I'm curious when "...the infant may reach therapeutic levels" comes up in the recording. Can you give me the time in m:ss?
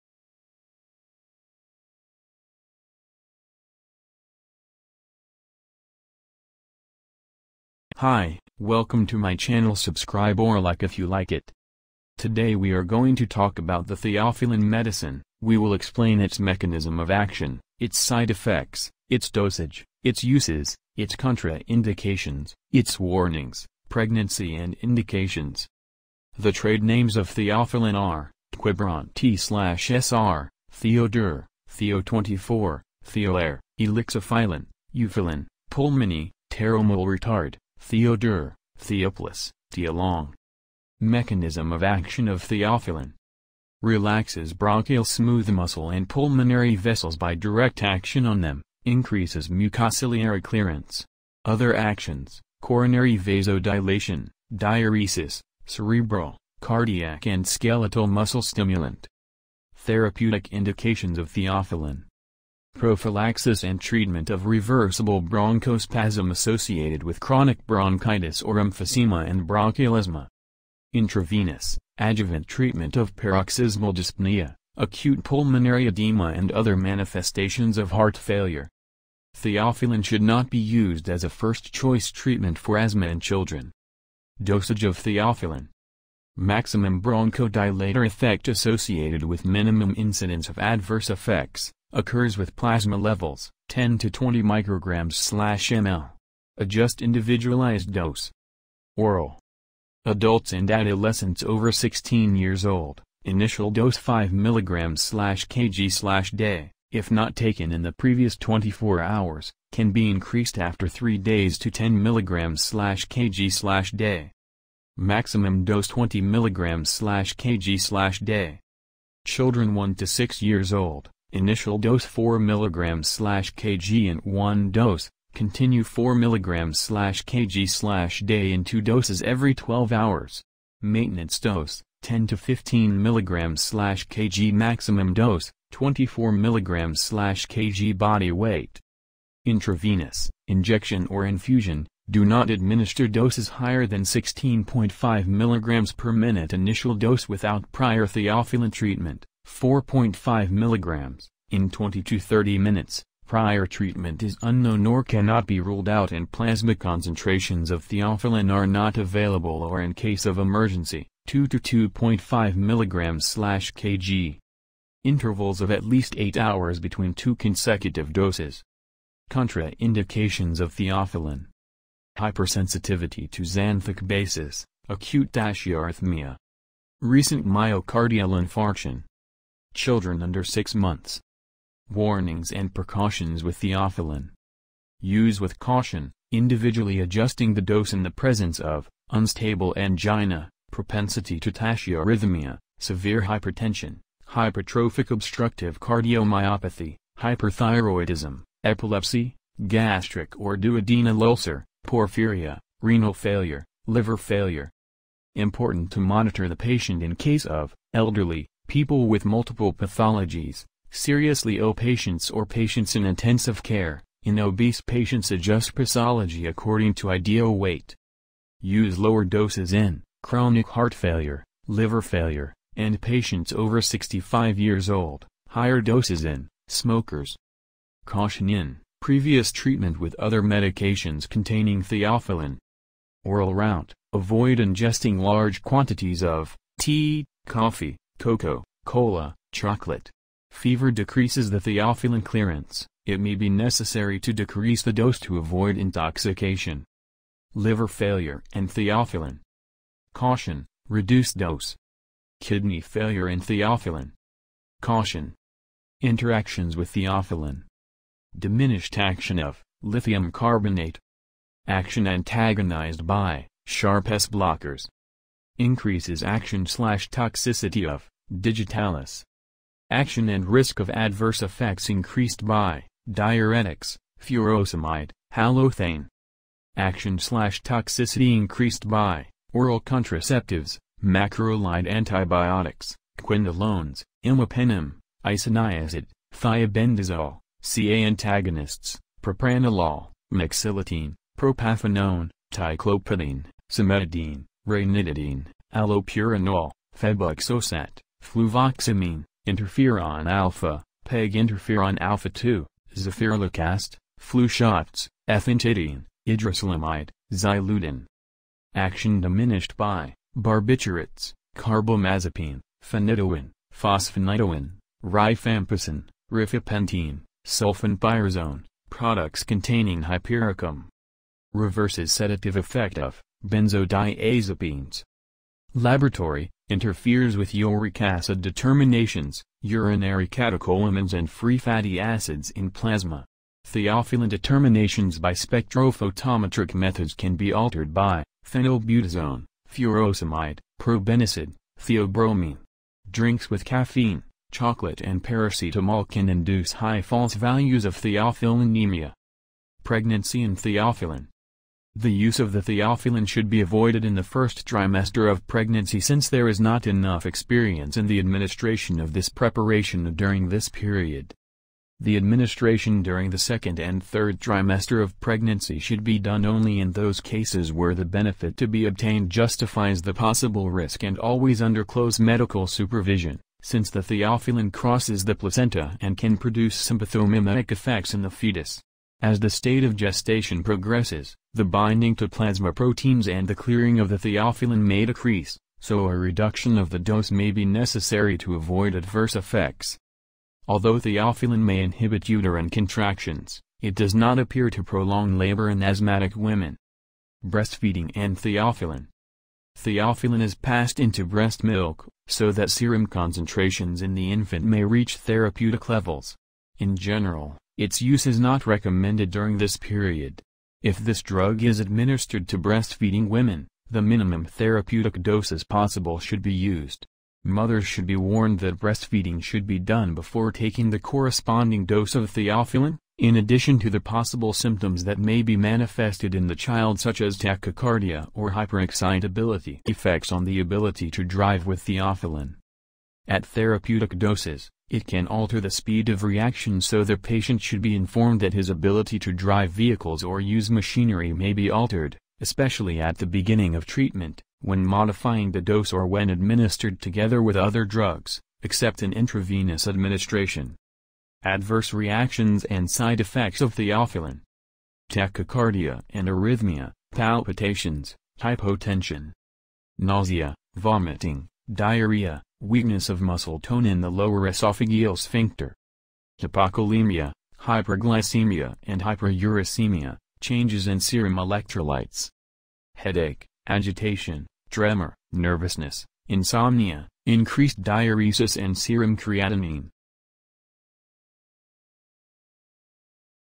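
6:44.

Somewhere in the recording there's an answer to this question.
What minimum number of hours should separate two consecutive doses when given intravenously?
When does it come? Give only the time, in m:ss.
2:46.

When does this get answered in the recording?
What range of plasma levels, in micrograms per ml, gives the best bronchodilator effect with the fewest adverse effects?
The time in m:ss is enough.
1:33.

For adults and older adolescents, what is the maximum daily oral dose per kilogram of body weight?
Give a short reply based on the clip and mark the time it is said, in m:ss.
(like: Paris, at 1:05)
20 mg/kg/day, at 1:55.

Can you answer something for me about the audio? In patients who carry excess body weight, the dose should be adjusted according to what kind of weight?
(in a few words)
ideal weight.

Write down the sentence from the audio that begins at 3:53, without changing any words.
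Oral route, avoid ingesting large quantities of tea, coffee, cocoa, cola, chocolate.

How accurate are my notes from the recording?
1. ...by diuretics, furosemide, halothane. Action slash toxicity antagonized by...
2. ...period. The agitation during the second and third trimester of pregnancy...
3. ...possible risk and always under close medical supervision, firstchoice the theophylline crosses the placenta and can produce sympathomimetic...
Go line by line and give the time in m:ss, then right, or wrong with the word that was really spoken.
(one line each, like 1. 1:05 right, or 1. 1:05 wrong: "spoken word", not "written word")
1. 4:32 wrong: "increased", not "antagonized"
2. 6:00 wrong: "administration", not "agitation"
3. 6:10 wrong: "since", not "firstchoice".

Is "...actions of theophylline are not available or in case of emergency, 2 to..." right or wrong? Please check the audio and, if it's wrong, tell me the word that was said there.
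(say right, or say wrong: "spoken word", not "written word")
wrong: "concentrations", not "actions".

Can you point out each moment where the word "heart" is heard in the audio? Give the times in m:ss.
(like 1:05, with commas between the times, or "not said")
1:17, 3:40.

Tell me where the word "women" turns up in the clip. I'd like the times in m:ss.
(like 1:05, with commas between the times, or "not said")
6:36, 6:53.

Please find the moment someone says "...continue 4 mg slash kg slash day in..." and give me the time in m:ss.
2:05.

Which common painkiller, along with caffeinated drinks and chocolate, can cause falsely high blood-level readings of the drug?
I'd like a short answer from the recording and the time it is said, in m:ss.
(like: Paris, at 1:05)
paracetamol, at 5:45.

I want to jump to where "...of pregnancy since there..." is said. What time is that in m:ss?
5:55.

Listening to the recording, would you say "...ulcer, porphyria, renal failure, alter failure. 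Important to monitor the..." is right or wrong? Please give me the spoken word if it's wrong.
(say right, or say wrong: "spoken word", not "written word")
wrong: "liver", not "alter".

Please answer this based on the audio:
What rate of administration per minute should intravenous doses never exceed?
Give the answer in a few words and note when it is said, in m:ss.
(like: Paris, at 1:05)
16.5 mg, at 2:24.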